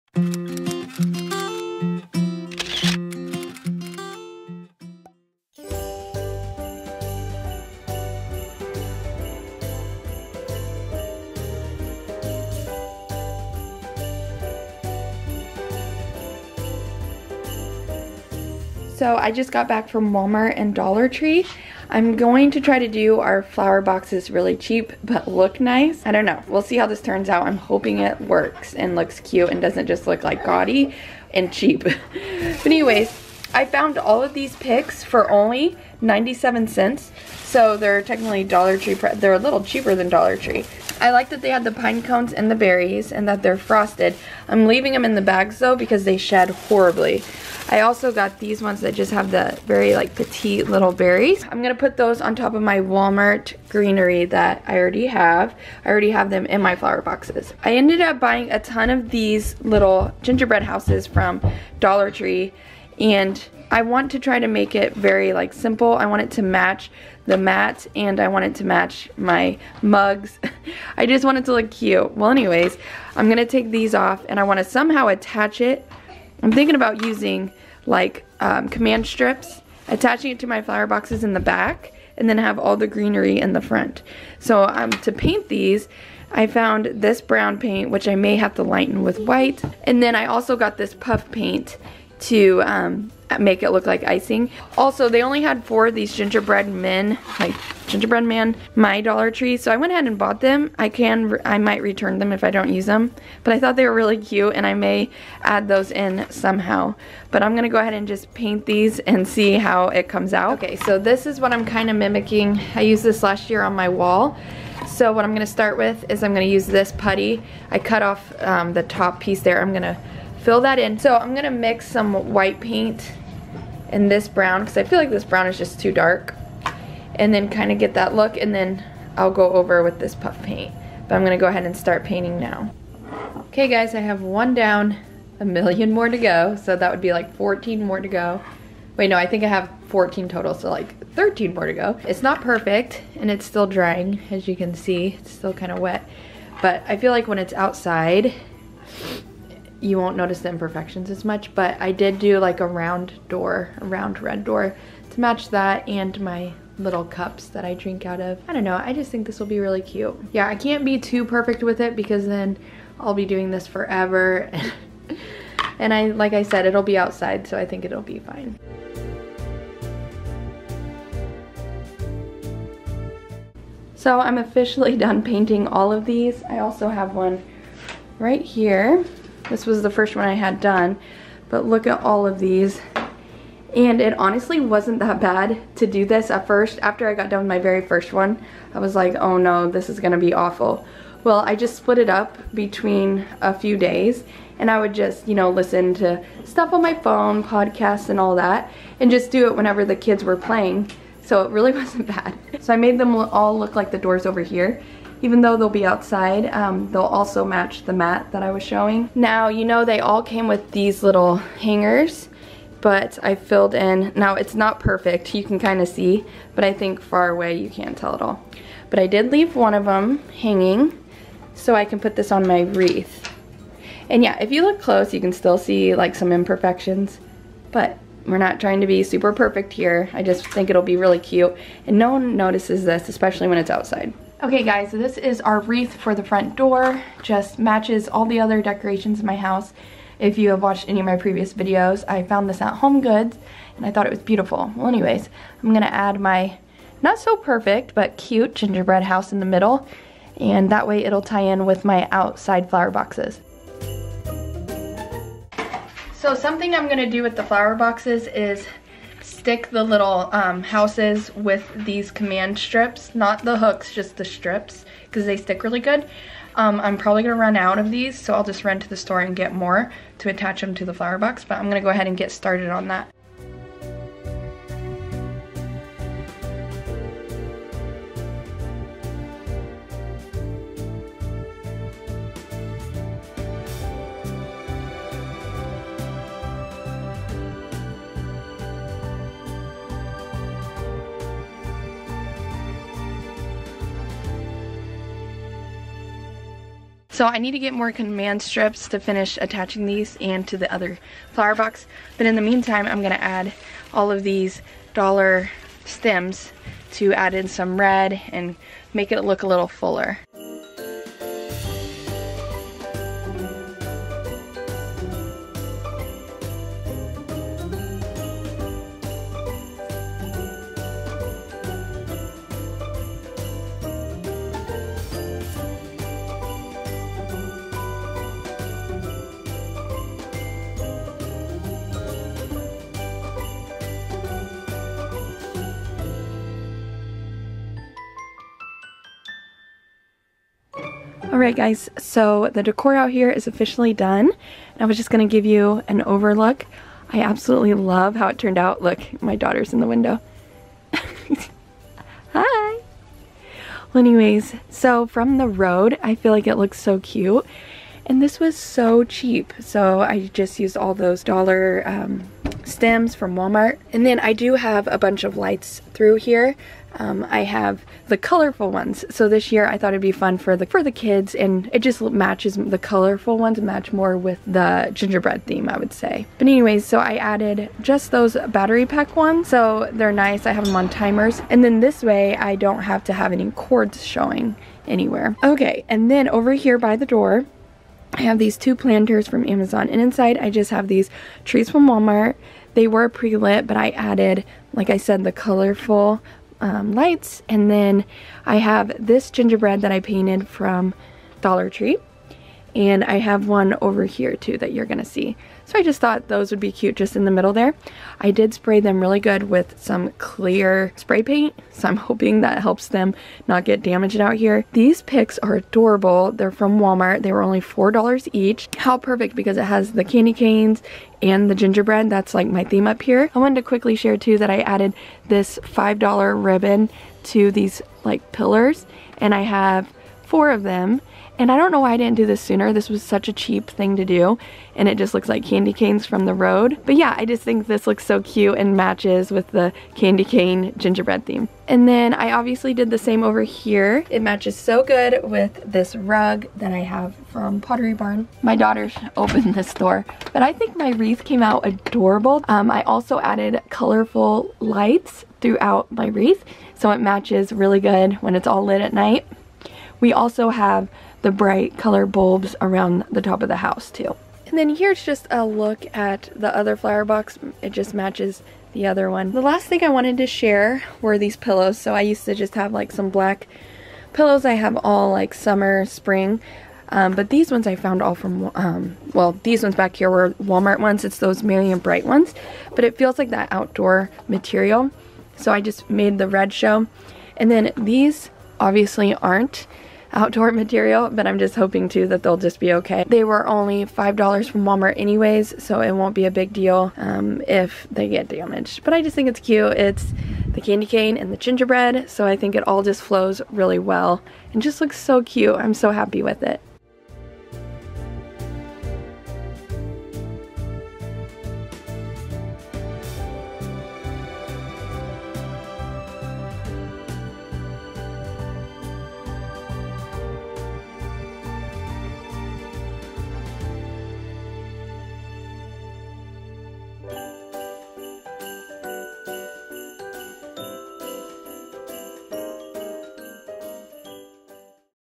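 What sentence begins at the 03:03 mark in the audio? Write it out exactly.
And it honestly wasn't that bad to do this at first.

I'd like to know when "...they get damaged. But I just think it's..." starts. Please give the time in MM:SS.
08:17.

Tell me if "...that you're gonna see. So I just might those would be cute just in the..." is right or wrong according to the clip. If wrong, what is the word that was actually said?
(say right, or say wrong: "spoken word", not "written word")
wrong: "thought", not "might".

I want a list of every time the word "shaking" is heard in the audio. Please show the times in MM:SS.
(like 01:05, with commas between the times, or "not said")
not said.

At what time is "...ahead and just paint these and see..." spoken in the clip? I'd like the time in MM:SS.
01:47.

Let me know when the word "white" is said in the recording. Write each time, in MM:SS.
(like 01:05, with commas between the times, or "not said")
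01:29, 02:02.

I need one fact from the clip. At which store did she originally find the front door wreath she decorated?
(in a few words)
Home Goods.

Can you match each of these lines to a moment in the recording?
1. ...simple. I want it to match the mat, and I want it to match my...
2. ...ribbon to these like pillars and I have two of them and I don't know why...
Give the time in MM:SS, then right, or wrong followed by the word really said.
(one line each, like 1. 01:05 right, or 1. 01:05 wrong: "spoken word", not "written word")
1. 01:05 right
2. 07:06 wrong: "four", not "two".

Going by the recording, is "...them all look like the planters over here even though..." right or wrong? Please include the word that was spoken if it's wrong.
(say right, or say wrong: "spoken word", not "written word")
wrong: "doors", not "planters".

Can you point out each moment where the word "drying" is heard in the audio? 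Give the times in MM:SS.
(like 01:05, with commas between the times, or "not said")
02:23.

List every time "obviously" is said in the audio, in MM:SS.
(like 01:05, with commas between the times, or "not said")
07:22, 08:08.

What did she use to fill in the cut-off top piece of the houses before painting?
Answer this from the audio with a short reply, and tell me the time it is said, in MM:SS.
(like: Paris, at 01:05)
putty, at 01:56.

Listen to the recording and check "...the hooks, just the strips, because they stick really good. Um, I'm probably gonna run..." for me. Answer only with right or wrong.
right.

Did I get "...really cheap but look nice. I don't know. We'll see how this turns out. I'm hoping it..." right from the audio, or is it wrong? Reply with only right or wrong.
right.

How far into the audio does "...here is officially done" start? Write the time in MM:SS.
05:43.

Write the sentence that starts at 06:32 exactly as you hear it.
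They were pre-lit but I added, like I said, the colorful um, lights.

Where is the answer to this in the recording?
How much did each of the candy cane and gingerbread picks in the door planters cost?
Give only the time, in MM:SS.
06:57.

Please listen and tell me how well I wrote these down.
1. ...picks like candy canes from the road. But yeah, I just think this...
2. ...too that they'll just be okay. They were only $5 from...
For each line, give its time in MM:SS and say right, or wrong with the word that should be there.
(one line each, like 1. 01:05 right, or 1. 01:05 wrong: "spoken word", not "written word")
1. 07:15 wrong: "looks", not "picks"
2. 08:11 right.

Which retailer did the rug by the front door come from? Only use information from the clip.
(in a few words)
Pottery Barn.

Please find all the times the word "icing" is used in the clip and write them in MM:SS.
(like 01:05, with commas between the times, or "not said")
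01:34.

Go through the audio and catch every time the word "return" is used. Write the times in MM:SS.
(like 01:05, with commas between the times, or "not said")
01:41.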